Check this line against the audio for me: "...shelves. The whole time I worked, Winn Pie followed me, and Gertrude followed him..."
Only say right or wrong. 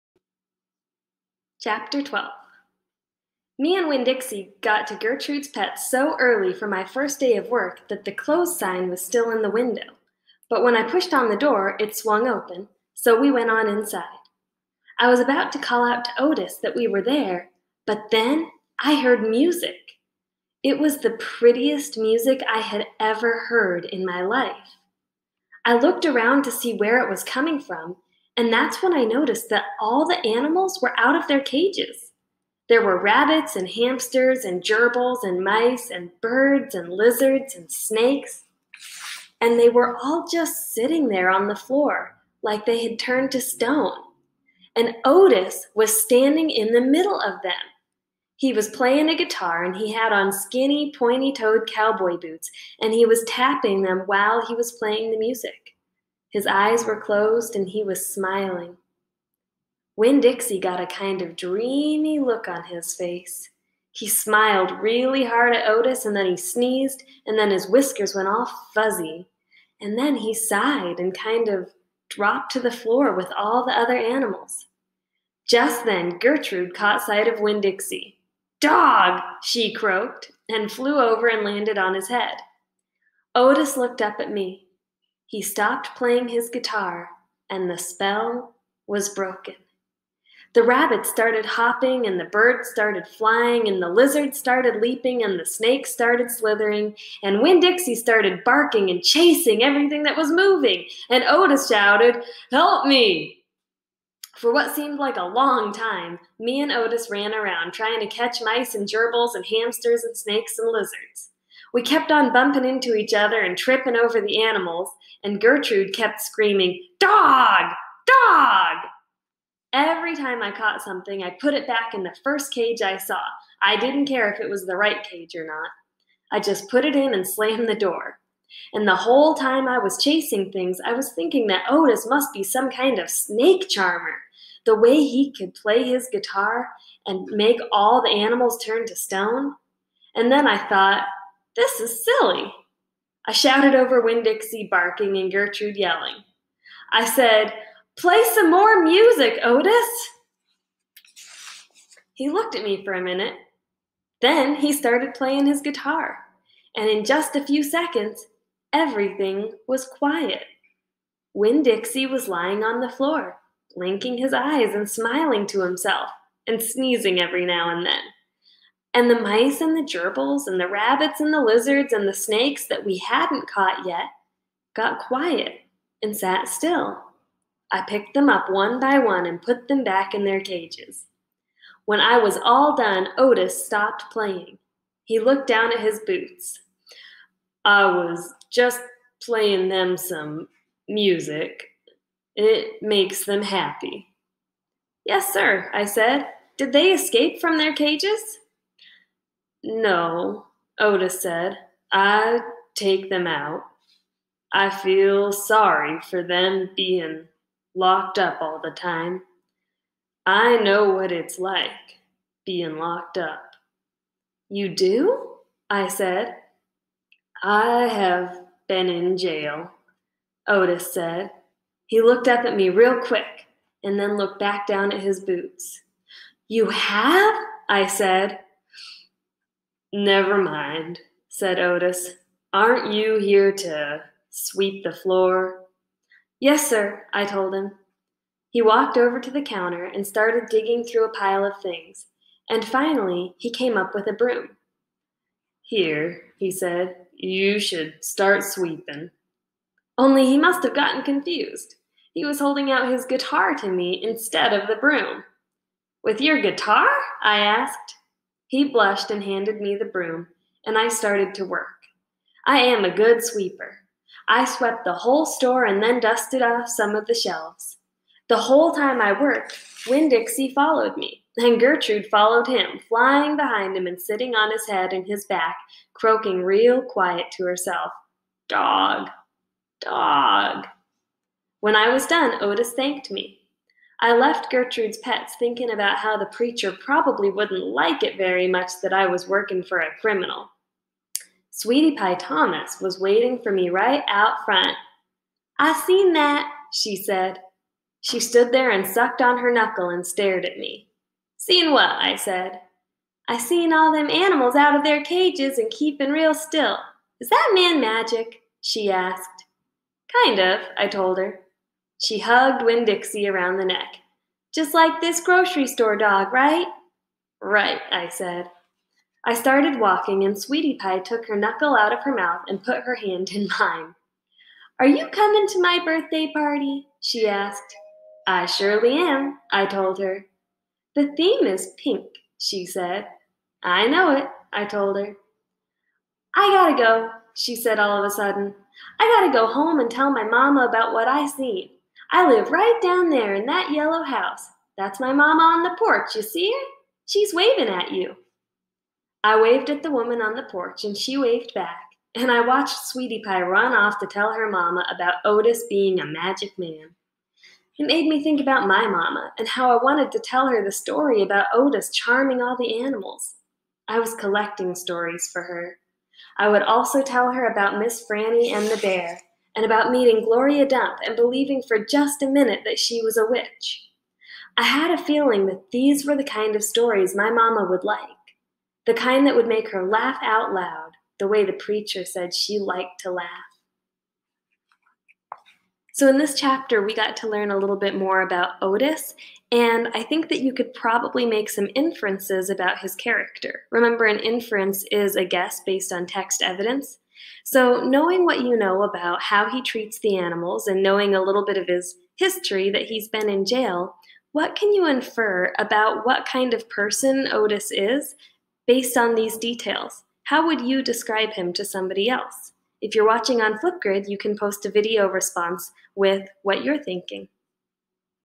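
wrong.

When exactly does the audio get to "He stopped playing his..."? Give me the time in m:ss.
1:25.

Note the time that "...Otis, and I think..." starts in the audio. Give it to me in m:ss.
6:28.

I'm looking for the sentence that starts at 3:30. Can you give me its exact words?
I know what it's like being locked up.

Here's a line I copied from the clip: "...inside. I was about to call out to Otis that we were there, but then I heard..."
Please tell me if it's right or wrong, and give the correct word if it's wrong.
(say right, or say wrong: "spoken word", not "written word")
right.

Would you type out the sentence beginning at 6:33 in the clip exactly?
Remember, an inference is a guess based on text evidence.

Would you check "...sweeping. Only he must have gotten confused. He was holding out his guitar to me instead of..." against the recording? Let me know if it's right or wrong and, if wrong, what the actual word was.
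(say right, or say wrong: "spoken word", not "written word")
right.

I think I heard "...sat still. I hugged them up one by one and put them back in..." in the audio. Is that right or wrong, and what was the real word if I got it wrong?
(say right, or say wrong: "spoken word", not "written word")
wrong: "picked", not "hugged".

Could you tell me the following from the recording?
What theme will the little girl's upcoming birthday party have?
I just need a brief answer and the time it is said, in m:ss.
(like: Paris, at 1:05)
Pink, at 5:31.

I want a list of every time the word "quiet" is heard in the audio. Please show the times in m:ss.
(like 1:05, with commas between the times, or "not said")
2:39, 2:54, 4:36.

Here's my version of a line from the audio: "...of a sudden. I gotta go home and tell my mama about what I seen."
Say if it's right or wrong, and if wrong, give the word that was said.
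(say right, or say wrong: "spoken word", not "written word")
right.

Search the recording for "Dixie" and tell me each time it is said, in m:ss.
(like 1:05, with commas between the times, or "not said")
0:04, 1:00, 1:17, 1:37, 2:24, 2:41, 4:30, 5:12.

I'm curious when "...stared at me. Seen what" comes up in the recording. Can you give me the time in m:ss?
5:00.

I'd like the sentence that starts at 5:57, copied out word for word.
It made me think about my mama and how I wanted to tell her the story about Otis charming all the animals.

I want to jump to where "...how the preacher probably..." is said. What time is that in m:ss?
4:45.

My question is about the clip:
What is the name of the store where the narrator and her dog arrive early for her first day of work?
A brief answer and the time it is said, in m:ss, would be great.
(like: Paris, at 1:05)
Gertrude's Pet, at 0:04.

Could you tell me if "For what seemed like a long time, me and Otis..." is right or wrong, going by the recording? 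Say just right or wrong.
right.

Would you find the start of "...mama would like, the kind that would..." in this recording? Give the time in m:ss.
6:17.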